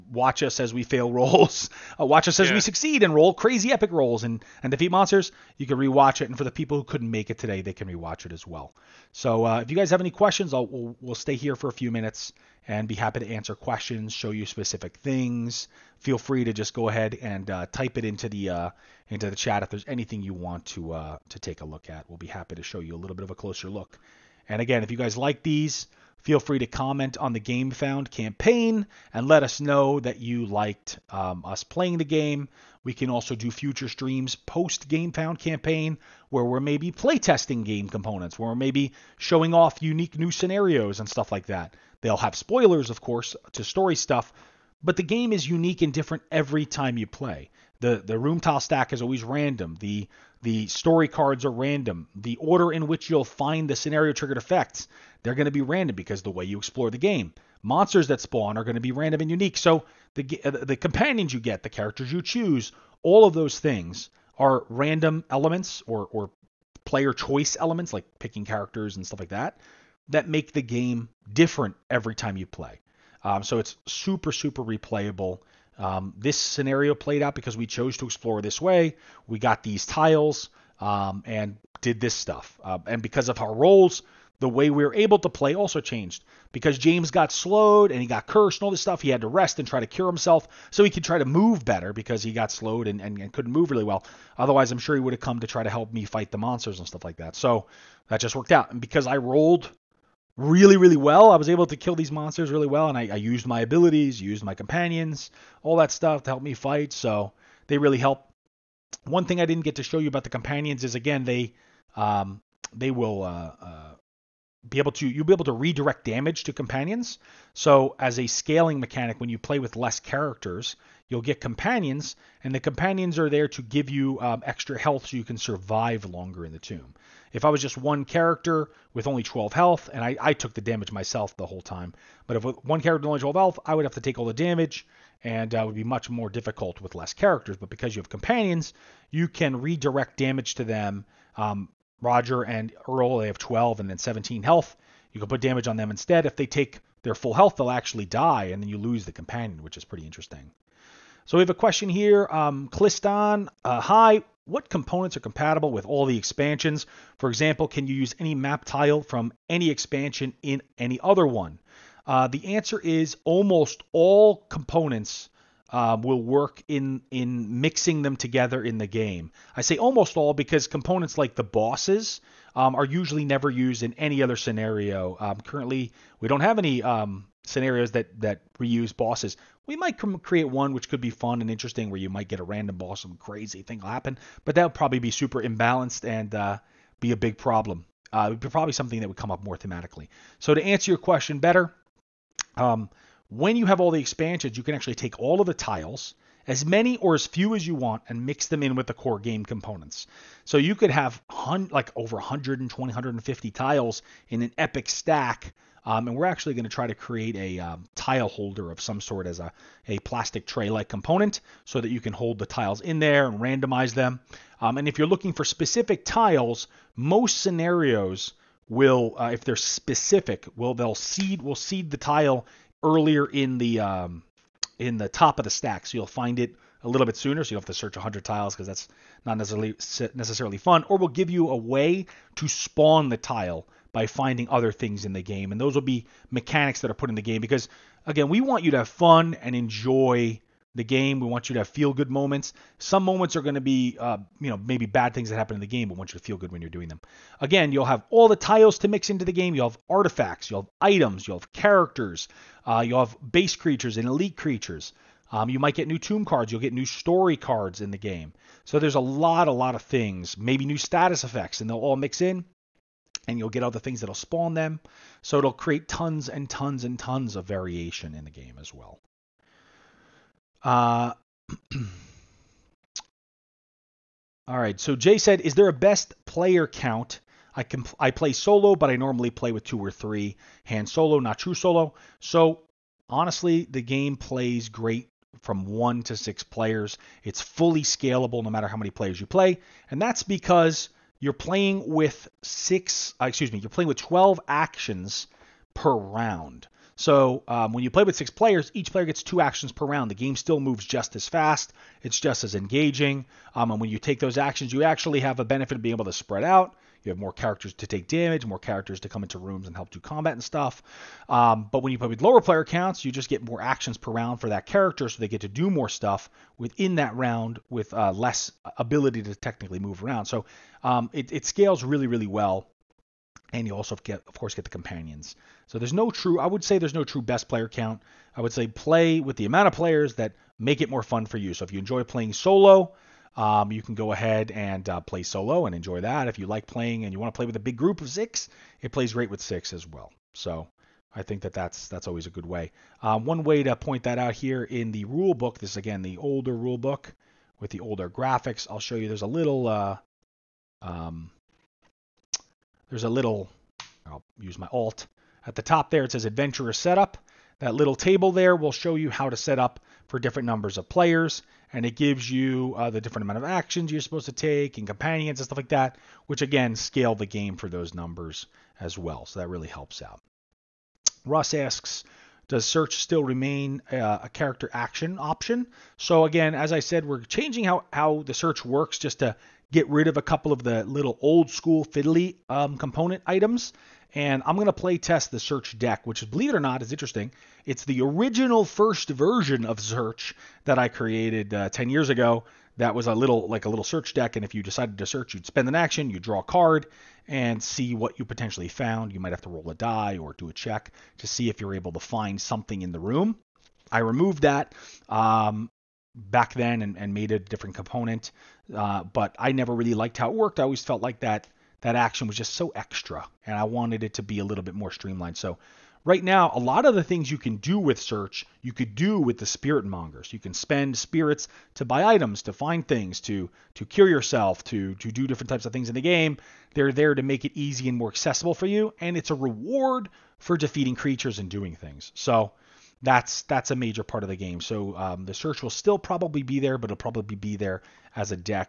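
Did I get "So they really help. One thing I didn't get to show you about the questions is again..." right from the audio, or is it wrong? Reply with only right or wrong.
wrong.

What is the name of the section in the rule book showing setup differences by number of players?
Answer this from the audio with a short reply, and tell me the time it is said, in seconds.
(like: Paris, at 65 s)
Adventurer Setup, at 356 s.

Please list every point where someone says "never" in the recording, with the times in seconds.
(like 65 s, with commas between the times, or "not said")
173 s, 409 s.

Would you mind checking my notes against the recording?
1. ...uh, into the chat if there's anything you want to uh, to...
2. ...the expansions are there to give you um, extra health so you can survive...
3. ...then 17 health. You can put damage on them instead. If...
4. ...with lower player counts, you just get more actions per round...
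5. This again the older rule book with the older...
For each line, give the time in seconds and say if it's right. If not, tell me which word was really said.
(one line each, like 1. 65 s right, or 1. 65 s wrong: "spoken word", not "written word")
1. 18 s right
2. 122 s wrong: "companions", not "expansions"
3. 143 s right
4. 312 s right
5. 345 s right.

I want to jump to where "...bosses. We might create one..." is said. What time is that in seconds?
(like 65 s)
178 s.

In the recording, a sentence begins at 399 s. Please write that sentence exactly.
You might have to roll a die or do a check to see if you're able to find something in the room.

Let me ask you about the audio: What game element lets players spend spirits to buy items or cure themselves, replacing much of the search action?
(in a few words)
Spiritmongers.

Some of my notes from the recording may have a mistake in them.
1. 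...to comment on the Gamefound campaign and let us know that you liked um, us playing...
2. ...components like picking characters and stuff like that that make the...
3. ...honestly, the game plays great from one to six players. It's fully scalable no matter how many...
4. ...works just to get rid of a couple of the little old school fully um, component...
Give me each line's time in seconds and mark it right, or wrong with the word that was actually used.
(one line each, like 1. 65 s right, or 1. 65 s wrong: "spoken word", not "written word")
1. 26 s right
2. 67 s wrong: "elements", not "components"
3. 283 s right
4. 378 s wrong: "fiddly", not "fully".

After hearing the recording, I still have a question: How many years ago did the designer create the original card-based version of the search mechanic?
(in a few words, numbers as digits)
10 years.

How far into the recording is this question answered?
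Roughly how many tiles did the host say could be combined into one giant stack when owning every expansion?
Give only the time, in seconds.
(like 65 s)
201 s.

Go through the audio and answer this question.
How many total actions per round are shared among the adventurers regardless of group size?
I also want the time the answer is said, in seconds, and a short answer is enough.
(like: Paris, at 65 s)
12, at 293 s.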